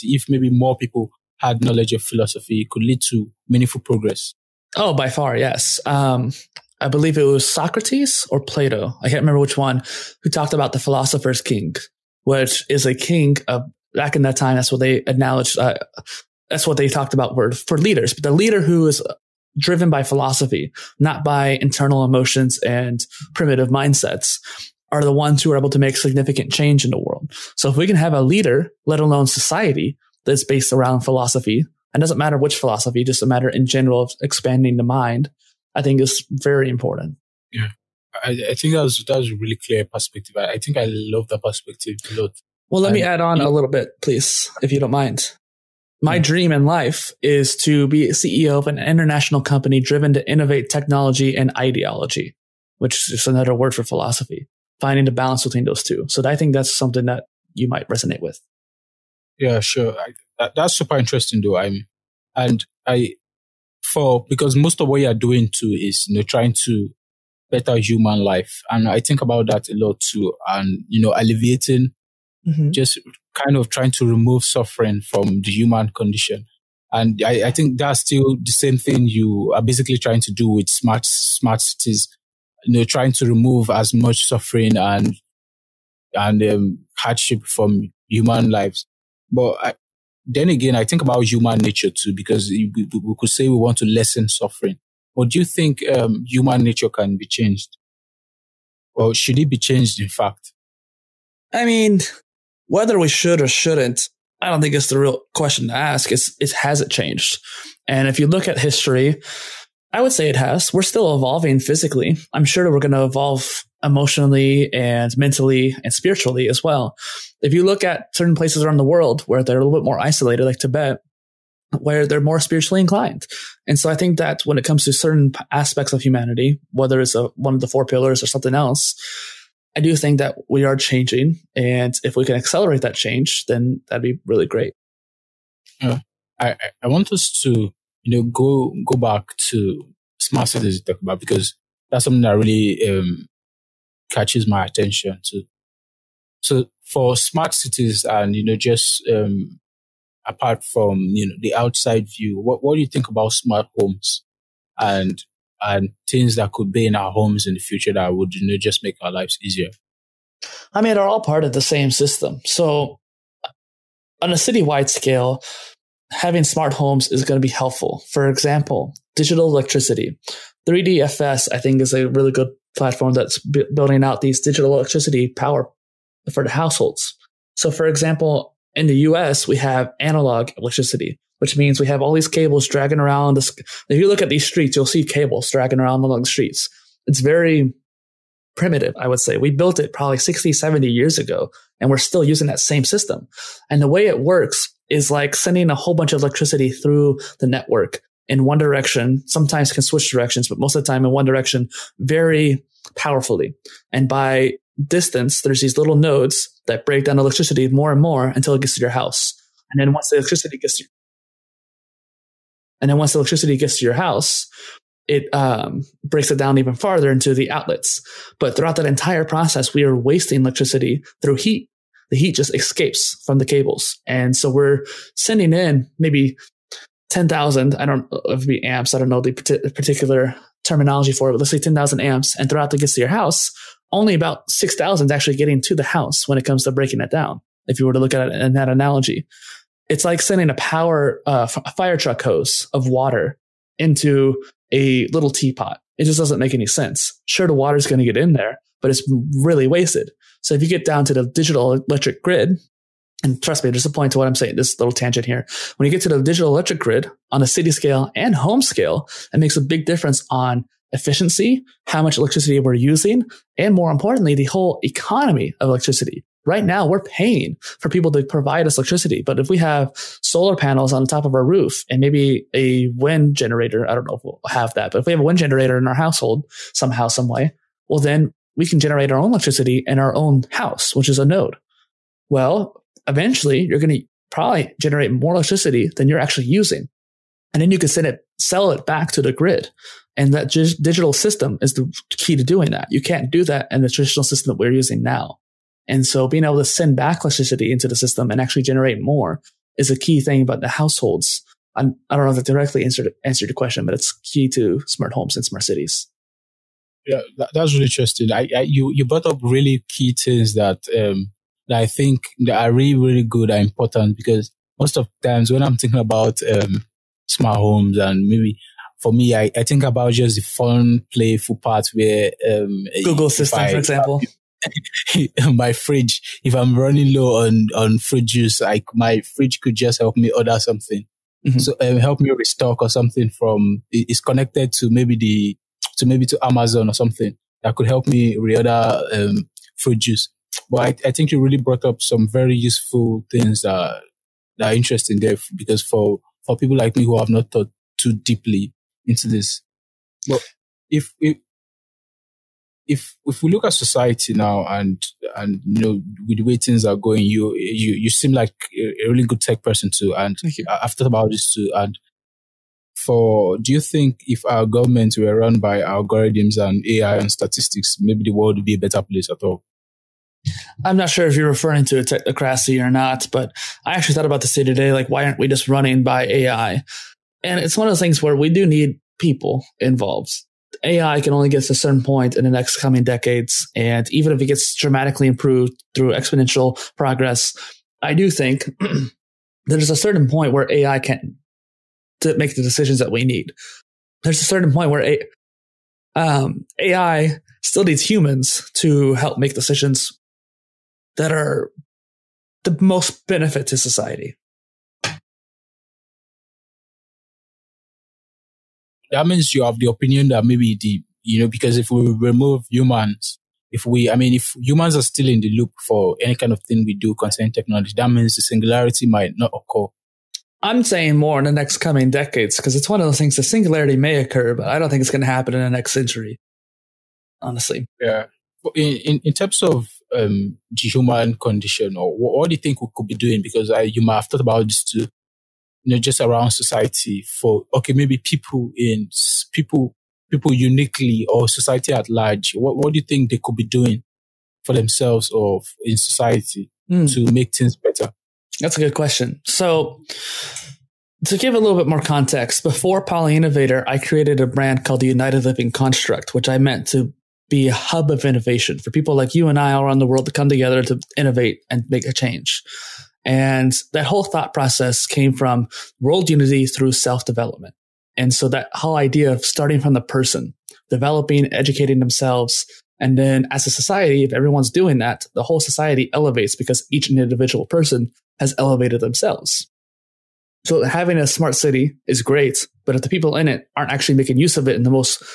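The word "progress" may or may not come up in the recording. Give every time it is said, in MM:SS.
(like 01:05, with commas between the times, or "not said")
00:03, 06:26.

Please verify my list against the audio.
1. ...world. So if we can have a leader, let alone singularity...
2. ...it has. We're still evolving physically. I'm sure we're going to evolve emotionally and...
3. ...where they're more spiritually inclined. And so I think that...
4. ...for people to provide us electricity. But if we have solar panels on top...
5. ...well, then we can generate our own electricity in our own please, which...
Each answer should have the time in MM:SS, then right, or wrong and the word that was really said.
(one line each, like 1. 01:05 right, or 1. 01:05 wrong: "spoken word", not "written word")
1. 00:26 wrong: "society", not "singularity"
2. 01:50 right
3. 02:01 right
4. 04:27 right
5. 04:37 wrong: "house", not "please".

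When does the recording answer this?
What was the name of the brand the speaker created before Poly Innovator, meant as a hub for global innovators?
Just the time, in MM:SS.
07:35.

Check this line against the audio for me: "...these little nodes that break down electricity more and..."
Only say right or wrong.
right.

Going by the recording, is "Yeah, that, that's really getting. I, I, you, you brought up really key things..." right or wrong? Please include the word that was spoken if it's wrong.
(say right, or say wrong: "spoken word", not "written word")
wrong: "interesting", not "getting".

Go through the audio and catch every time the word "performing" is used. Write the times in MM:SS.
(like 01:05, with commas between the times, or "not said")
not said.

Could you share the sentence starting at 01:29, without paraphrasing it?
But I, then again, I think about human nature too, because we, we, could say we want to lessen suffering.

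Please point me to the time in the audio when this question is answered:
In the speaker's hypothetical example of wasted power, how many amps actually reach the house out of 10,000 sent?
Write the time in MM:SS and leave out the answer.
03:54.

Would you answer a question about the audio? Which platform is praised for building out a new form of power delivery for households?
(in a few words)
3DFS.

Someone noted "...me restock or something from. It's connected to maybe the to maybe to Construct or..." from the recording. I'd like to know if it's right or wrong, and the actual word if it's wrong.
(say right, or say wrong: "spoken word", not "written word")
wrong: "Amazon", not "Construct".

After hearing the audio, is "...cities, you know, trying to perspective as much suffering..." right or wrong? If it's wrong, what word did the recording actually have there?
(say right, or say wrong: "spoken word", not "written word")
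wrong: "remove", not "perspective".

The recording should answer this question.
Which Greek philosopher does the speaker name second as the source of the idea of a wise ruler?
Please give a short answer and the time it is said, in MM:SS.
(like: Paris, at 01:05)
Plato, at 00:08.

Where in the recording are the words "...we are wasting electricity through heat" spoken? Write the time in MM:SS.
03:39.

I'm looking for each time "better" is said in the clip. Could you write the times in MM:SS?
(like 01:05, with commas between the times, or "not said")
01:07, 06:08, 07:27.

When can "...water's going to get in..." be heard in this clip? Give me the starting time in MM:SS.
04:07.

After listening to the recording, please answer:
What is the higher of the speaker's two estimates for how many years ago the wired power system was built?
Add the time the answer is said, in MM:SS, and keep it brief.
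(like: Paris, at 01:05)
70, at 03:10.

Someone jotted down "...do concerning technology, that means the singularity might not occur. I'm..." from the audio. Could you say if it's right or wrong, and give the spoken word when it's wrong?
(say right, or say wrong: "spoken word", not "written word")
right.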